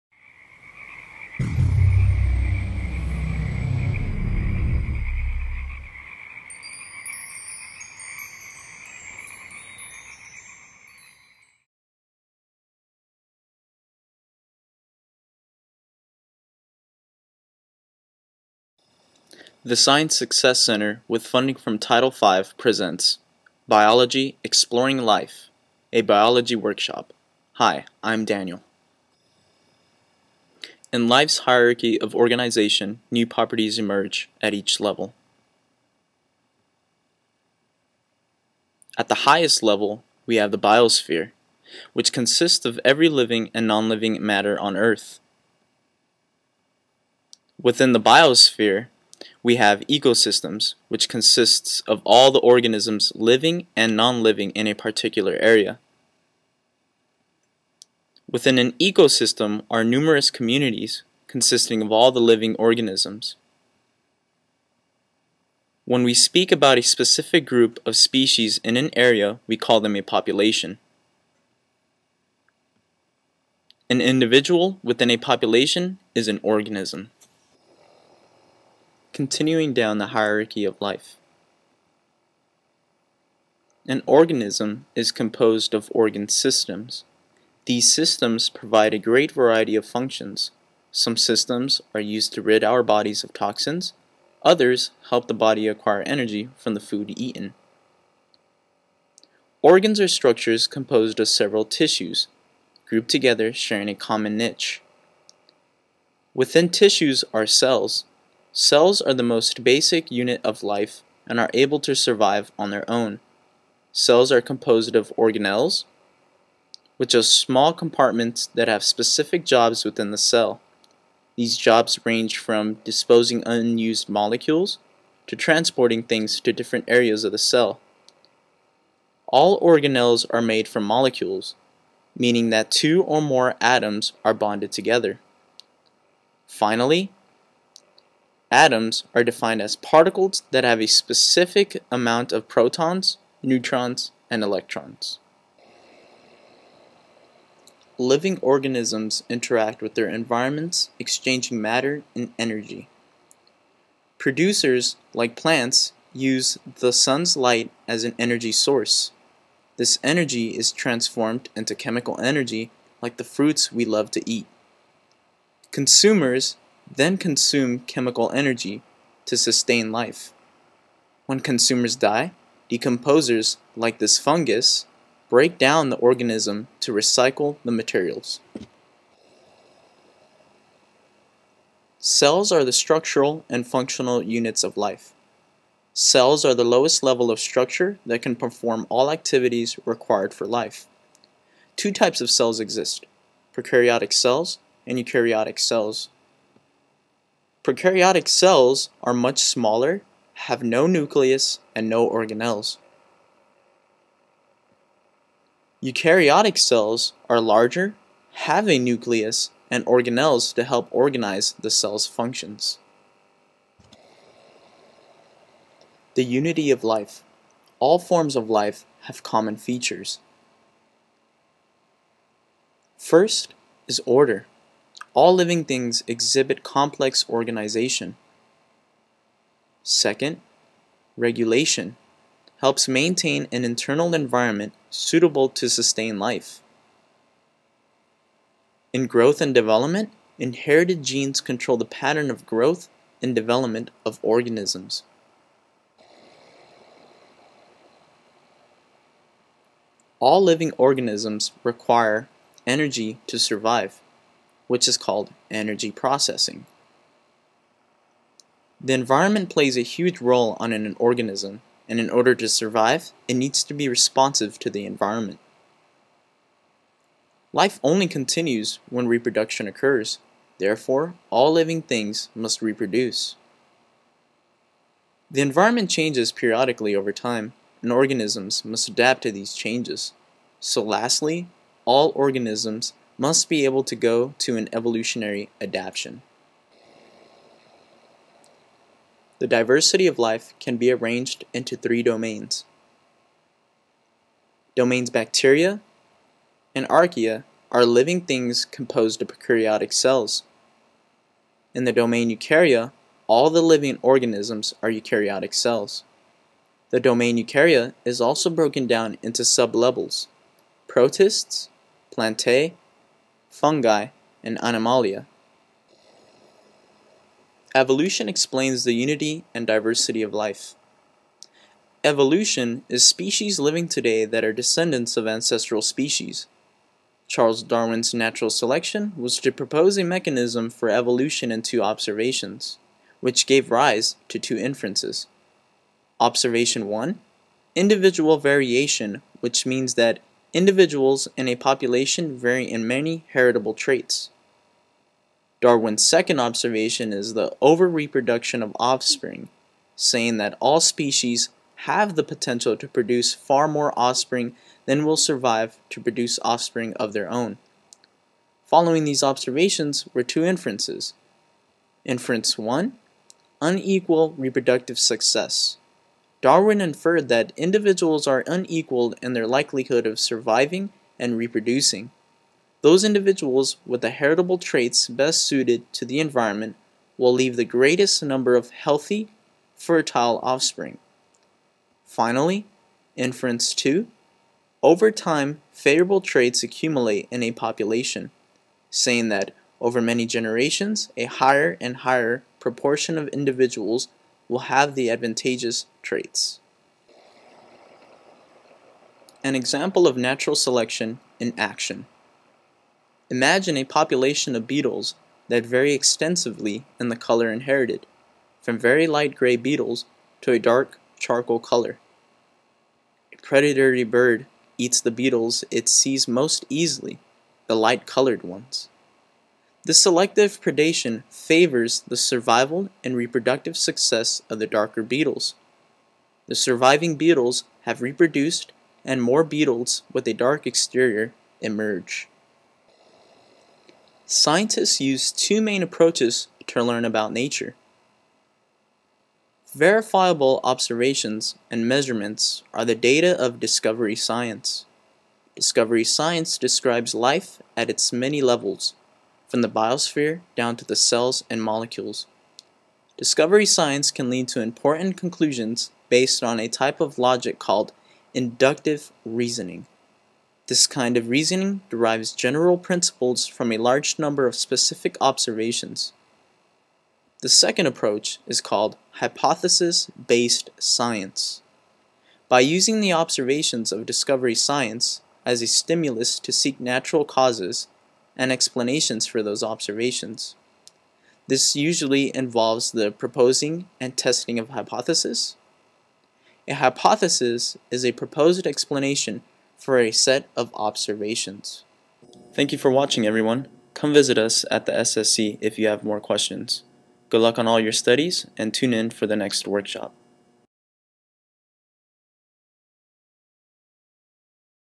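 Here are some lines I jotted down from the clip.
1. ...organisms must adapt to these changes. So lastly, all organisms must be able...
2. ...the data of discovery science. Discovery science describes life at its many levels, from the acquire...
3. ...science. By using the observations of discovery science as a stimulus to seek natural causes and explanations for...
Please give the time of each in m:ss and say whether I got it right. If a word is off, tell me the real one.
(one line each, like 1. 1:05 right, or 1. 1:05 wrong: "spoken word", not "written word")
1. 4:37 right
2. 7:22 wrong: "biosphere", not "acquire"
3. 7:50 right.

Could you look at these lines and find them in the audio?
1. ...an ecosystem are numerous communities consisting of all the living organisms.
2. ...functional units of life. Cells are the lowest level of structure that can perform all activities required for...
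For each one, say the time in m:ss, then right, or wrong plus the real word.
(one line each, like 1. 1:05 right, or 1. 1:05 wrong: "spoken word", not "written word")
1. 0:58 right
2. 3:03 right.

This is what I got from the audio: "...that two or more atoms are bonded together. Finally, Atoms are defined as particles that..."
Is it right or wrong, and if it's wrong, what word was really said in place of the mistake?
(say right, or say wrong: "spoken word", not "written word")
right.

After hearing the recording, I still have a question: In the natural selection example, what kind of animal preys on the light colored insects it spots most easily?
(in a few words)
predatory bird.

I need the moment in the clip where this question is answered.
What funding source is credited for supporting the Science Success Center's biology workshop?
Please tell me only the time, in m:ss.
0:21.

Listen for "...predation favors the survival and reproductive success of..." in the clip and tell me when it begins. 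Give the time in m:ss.
7:00.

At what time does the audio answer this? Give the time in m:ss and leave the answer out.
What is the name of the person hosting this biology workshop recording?
0:28.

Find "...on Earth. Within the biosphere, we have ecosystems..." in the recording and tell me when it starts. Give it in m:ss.
0:44.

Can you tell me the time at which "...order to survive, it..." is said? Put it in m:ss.
4:22.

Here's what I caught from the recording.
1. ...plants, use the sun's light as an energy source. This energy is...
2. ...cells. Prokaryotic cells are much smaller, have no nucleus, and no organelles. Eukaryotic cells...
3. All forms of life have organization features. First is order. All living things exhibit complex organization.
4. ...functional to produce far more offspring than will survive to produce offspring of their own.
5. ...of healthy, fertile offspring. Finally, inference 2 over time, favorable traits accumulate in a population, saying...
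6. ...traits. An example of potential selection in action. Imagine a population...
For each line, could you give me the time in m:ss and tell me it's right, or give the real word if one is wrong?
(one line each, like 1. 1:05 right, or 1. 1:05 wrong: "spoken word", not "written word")
1. 2:35 right
2. 3:15 right
3. 3:37 wrong: "common", not "organization"
4. 5:52 wrong: "potential", not "functional"
5. 6:18 right
6. 6:36 wrong: "natural", not "potential".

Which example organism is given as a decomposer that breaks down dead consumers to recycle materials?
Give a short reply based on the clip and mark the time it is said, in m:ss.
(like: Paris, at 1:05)
fungus, at 2:54.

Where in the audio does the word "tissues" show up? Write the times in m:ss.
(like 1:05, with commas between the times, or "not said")
1:41, 1:46.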